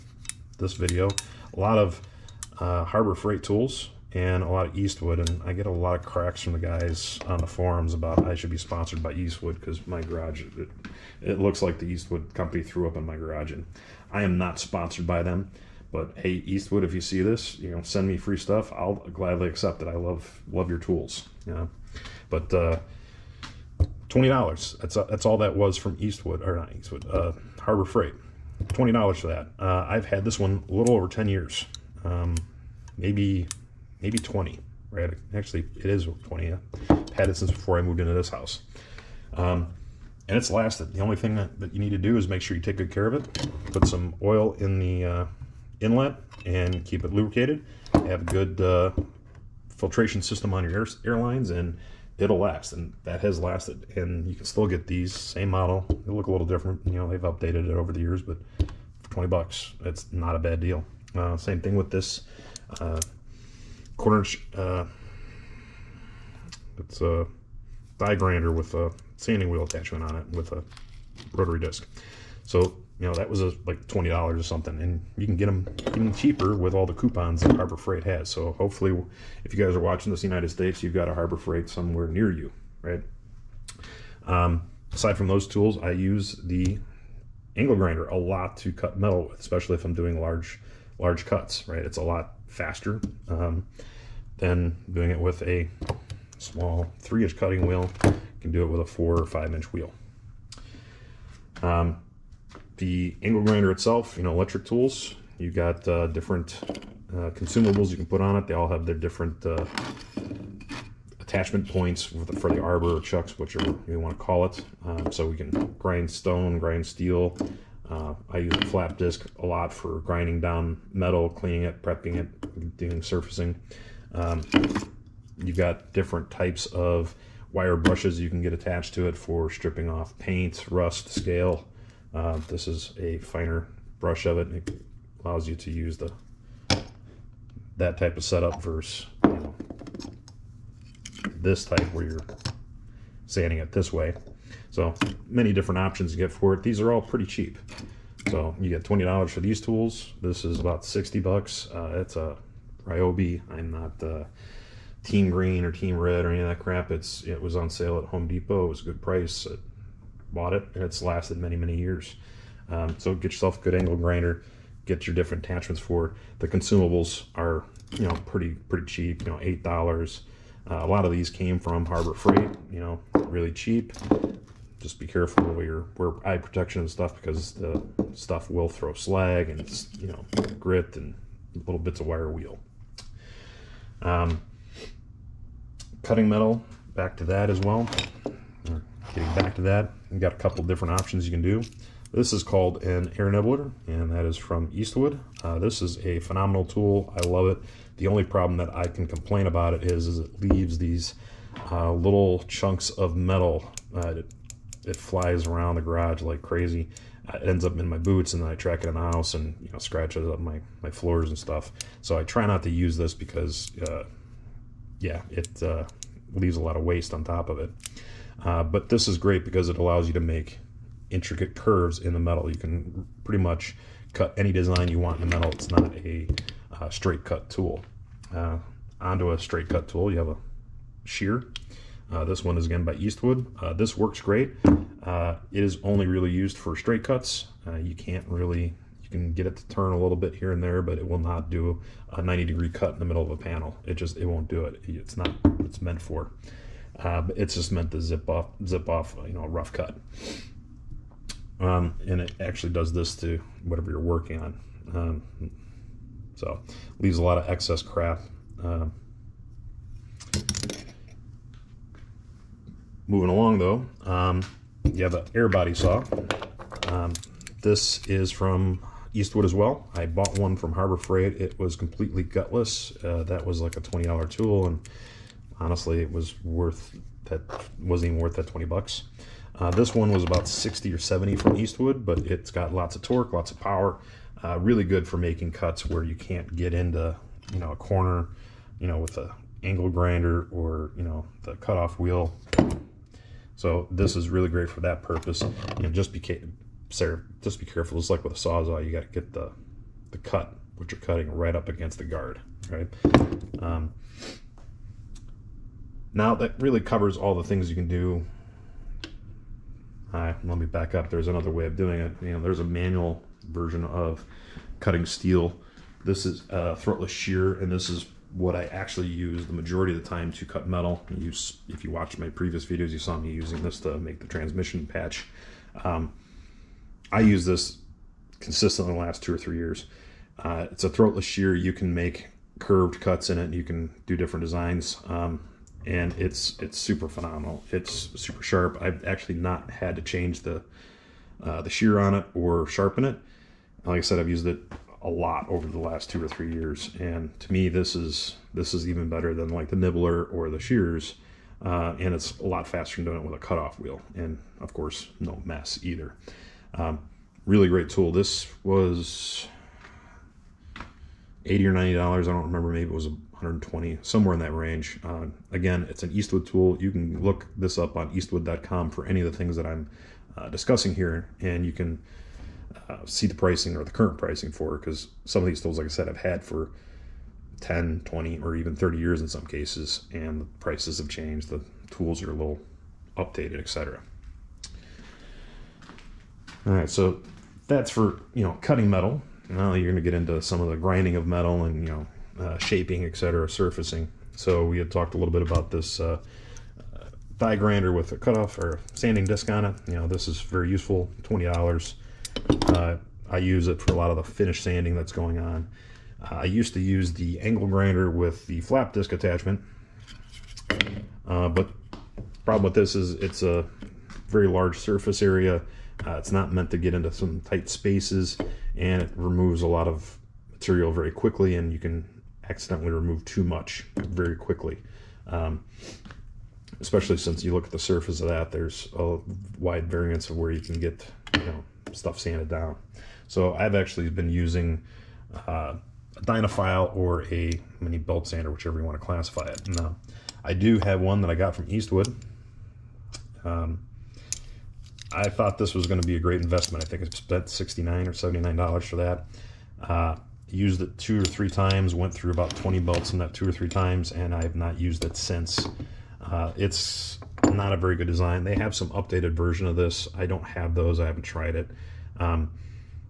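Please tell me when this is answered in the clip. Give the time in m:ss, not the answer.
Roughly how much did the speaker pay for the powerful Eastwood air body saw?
4:40.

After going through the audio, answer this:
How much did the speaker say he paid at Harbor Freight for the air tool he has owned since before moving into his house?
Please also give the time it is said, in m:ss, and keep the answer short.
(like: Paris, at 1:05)
$20, at 0:28.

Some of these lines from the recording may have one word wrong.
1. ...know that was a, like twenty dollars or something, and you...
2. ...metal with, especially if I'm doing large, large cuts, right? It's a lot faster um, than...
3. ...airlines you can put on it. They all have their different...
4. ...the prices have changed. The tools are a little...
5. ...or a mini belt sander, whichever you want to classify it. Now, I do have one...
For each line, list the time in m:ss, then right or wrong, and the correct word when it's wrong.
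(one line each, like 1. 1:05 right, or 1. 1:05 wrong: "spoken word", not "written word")
1. 1:13 right
2. 1:28 right
3. 1:47 wrong: "consumables", not "airlines"
4. 6:20 right
5. 7:16 right.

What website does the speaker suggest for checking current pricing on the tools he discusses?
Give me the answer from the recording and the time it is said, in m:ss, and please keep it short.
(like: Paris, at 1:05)
eastwood.com, at 6:08.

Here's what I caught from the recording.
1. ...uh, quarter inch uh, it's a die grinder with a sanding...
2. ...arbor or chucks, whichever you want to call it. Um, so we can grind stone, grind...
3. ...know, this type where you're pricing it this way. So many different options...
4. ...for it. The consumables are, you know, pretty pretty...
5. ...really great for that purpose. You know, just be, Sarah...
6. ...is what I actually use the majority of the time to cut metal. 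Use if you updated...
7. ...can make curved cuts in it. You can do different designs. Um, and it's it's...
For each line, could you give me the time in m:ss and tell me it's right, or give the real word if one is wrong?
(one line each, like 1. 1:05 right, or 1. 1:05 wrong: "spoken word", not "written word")
1. 1:02 right
2. 1:52 right
3. 2:19 wrong: "sanding", not "pricing"
4. 2:45 right
5. 4:54 right
6. 5:17 wrong: "watched", not "updated"
7. 5:31 right.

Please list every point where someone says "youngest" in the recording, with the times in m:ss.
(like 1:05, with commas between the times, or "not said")
not said.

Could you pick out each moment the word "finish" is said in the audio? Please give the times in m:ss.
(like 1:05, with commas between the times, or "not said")
6:44.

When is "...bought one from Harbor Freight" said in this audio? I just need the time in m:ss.
4:30.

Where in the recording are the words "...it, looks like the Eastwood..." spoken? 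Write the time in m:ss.
0:11.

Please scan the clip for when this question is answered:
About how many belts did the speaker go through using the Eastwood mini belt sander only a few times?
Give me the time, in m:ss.
7:32.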